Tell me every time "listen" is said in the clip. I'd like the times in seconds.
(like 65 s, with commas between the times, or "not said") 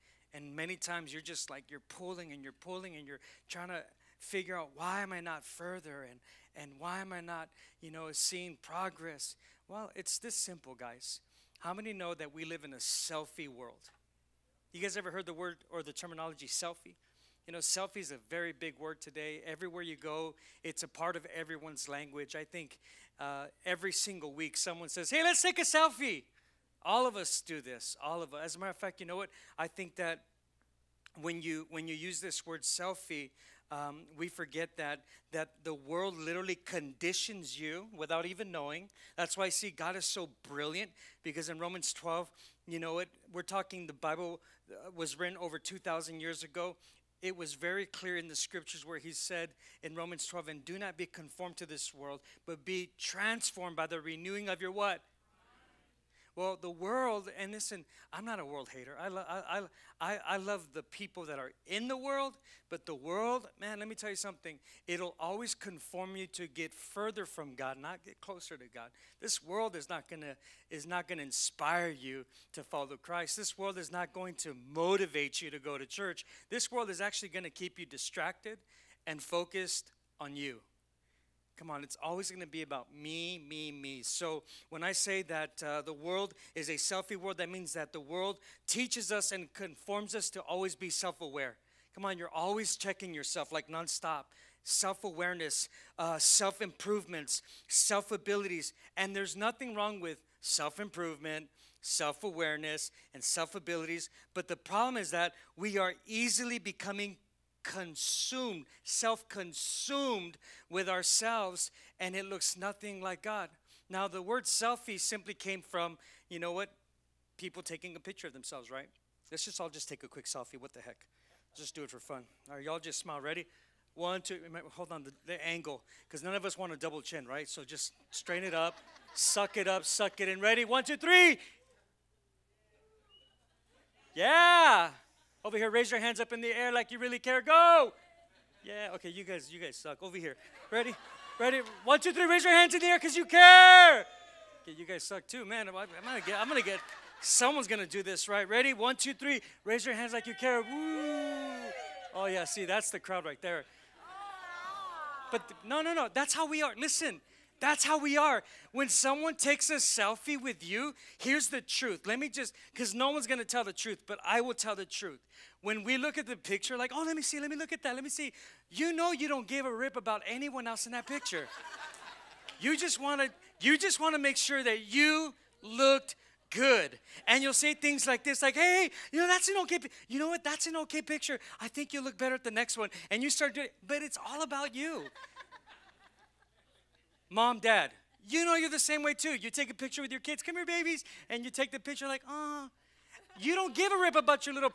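57 s, 156 s.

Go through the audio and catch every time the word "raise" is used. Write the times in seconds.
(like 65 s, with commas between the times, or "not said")
135 s, 142 s, 149 s.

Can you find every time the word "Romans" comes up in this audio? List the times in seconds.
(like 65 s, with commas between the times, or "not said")
41 s, 49 s.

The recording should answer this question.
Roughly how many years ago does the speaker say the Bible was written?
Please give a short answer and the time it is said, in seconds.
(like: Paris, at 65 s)
over 2,000, at 45 s.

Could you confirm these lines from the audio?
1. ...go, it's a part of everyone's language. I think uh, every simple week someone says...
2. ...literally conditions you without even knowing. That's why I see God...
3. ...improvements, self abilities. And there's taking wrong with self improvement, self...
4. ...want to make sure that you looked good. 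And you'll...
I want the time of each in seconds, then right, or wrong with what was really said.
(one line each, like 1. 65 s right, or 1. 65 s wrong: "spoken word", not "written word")
1. 19 s wrong: "single", not "simple"
2. 36 s right
3. 96 s wrong: "nothing", not "taking"
4. 173 s right.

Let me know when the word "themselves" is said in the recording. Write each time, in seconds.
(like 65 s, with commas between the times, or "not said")
118 s.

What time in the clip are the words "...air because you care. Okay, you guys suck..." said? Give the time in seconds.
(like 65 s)
142 s.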